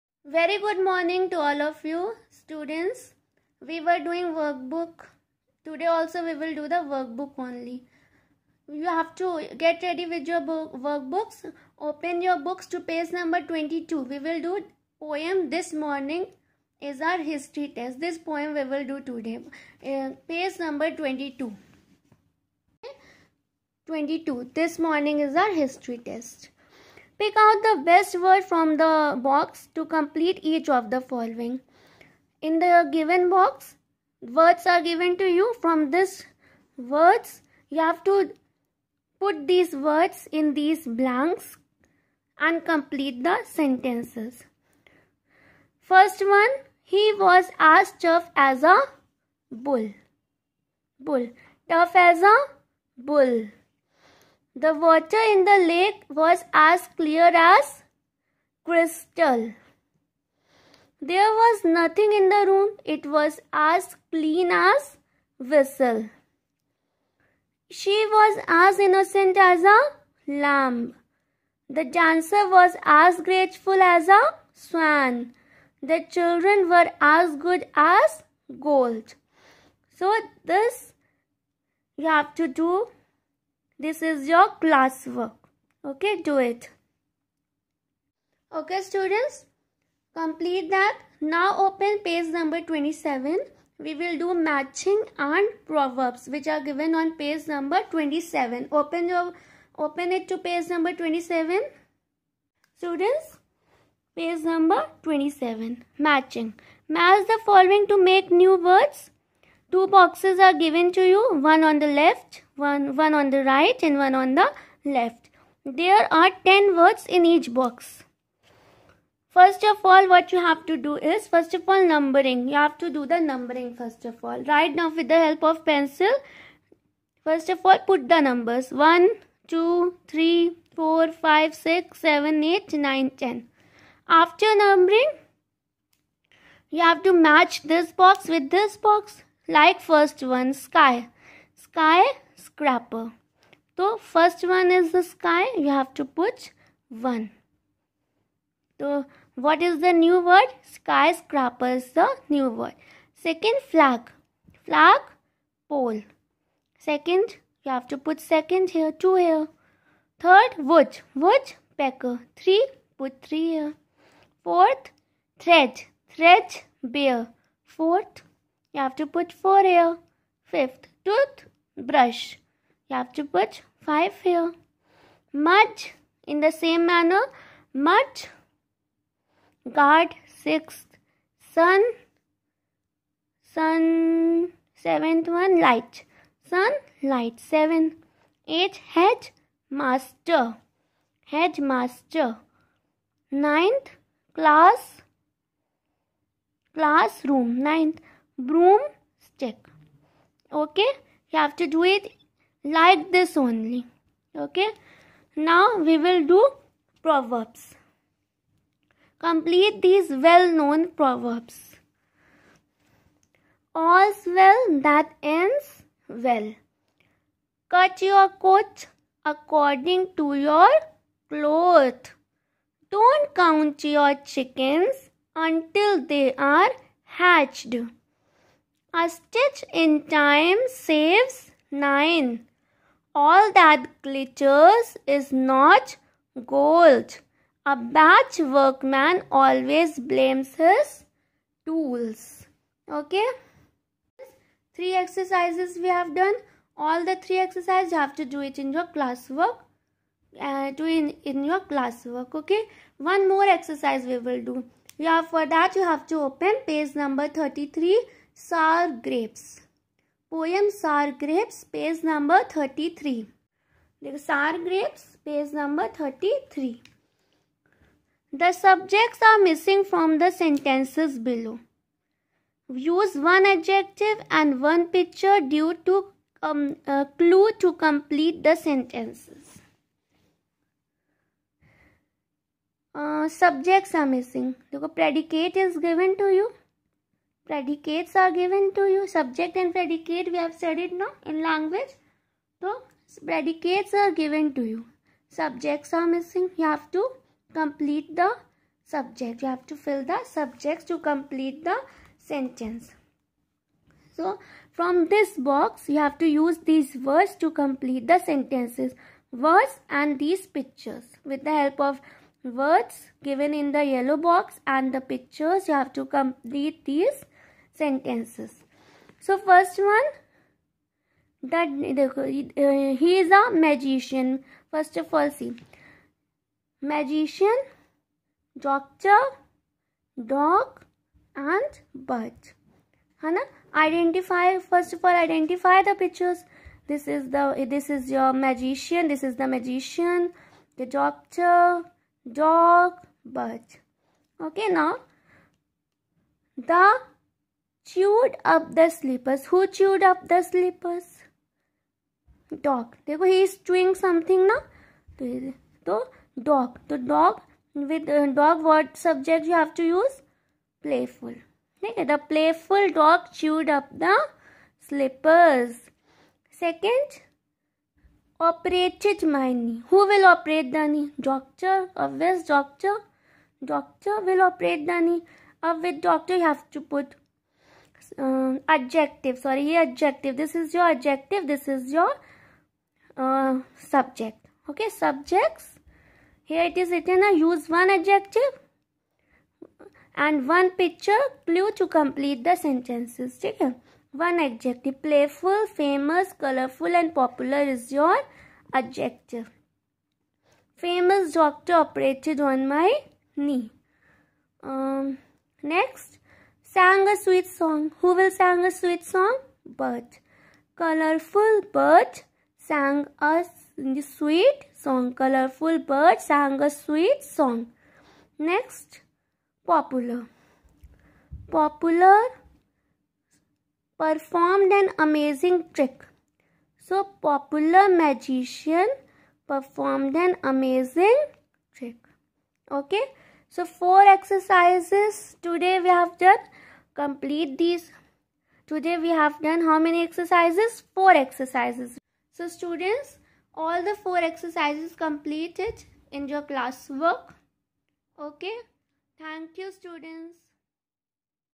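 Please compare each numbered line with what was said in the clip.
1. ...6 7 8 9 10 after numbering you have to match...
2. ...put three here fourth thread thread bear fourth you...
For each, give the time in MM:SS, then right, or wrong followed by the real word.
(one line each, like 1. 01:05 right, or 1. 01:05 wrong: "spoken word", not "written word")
1. 02:11 right
2. 02:43 right.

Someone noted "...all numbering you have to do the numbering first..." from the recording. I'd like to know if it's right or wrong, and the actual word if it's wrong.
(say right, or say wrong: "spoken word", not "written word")
right.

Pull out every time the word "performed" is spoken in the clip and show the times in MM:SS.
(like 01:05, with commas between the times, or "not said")
07:03, 07:09.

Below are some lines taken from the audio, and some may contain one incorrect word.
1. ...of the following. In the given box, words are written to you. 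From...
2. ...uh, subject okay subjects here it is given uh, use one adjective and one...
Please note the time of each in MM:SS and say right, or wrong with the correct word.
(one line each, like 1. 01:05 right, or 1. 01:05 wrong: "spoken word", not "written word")
1. 00:30 wrong: "given", not "written"
2. 06:23 wrong: "written", not "given".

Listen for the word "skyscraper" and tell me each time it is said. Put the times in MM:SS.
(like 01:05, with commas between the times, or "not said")
02:30.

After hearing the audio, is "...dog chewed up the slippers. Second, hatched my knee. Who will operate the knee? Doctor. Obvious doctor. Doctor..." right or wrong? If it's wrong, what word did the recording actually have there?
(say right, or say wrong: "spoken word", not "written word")
wrong: "operated", not "hatched".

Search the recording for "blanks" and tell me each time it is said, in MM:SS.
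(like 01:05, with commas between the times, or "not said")
00:40.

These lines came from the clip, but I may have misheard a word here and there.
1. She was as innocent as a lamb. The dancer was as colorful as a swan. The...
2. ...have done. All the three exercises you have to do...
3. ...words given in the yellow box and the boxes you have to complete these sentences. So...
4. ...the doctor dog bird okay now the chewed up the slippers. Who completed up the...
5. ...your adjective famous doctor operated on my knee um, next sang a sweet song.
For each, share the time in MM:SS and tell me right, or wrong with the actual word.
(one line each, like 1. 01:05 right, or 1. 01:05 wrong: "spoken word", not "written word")
1. 01:07 wrong: "grateful", not "colorful"
2. 04:05 right
3. 05:12 wrong: "pictures", not "boxes"
4. 05:40 wrong: "chewed", not "completed"
5. 06:37 right.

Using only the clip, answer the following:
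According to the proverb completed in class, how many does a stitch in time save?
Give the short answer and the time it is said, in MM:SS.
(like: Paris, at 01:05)
9, at 03:51.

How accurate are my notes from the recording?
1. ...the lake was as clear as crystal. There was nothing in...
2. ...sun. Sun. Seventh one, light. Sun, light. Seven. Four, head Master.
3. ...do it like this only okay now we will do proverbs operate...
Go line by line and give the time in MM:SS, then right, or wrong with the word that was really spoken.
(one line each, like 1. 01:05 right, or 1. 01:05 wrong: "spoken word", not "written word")
1. 00:55 right
2. 03:01 wrong: "Eight", not "Four"
3. 03:21 wrong: "complete", not "operate".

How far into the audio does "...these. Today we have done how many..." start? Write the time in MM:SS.
07:17.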